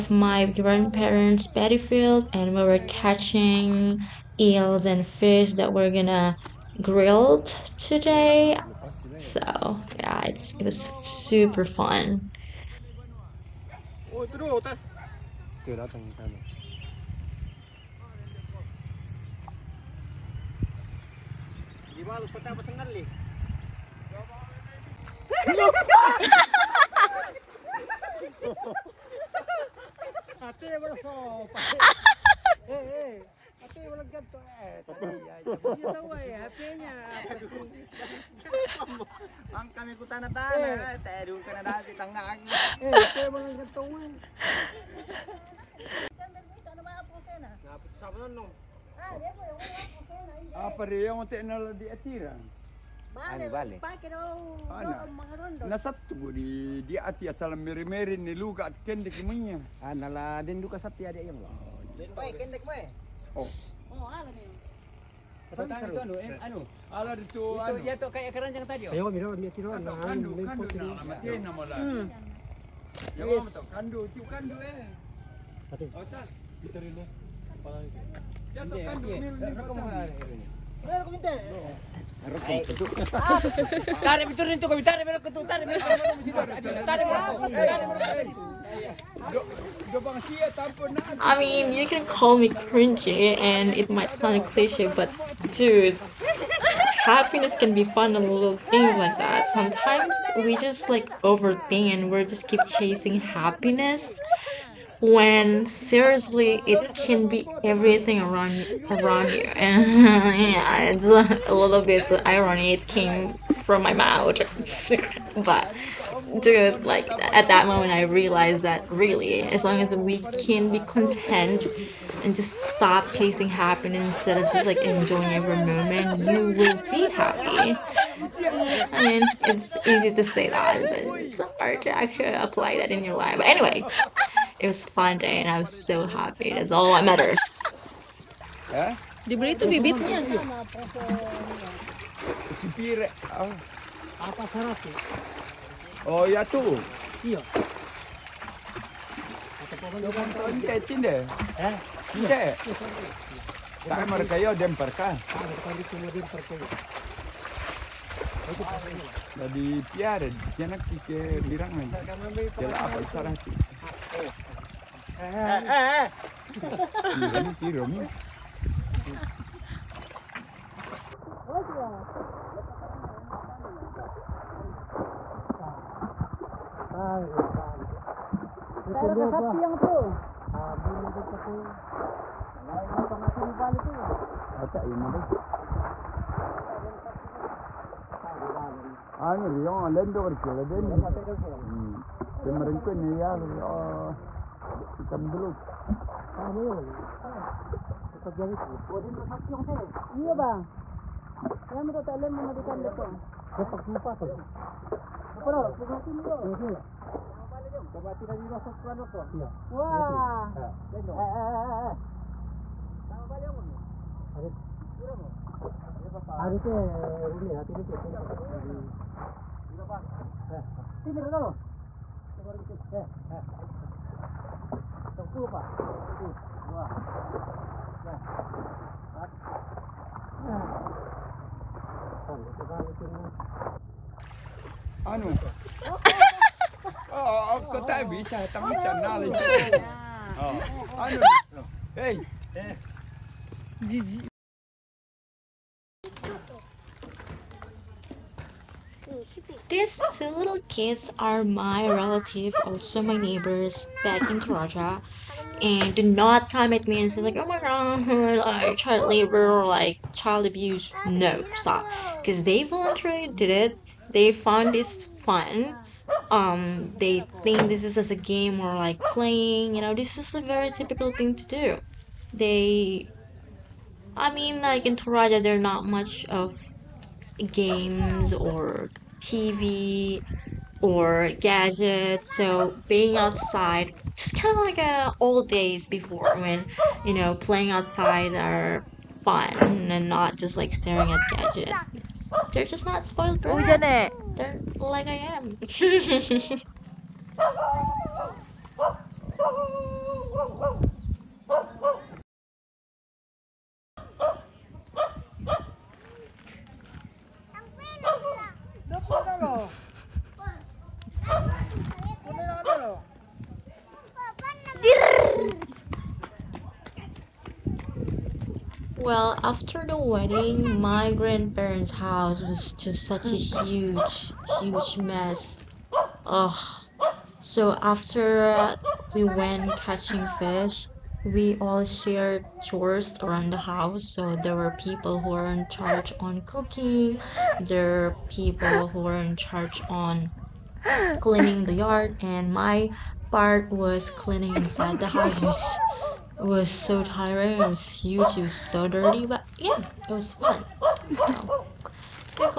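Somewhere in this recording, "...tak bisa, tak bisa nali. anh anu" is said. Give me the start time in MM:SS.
03:57.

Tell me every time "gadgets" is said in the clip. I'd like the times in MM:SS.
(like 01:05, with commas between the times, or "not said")
04:41, 04:51.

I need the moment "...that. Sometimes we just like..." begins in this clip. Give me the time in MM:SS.
01:39.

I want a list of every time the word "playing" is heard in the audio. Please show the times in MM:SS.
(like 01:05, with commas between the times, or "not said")
04:29, 04:47.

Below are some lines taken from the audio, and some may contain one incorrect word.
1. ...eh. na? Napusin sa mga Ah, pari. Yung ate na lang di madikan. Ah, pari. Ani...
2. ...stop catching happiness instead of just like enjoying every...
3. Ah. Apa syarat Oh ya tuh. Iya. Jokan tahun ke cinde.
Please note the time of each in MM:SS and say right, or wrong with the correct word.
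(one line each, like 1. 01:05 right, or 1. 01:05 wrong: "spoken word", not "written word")
1. 00:47 wrong: "atiran", not "madikan"
2. 02:02 wrong: "chasing", not "catching"
3. 02:23 right.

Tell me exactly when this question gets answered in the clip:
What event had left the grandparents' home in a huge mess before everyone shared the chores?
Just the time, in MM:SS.
05:19.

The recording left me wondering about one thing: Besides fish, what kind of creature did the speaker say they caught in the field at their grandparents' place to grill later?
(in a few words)
Eels.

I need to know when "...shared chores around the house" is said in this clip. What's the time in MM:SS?
05:31.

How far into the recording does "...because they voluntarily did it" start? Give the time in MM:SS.
04:22.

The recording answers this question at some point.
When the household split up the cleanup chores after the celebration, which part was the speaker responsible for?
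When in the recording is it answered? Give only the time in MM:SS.
05:44.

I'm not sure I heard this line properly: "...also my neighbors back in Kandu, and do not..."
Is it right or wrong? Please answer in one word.
wrong.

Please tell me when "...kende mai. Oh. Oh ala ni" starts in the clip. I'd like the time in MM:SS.
01:02.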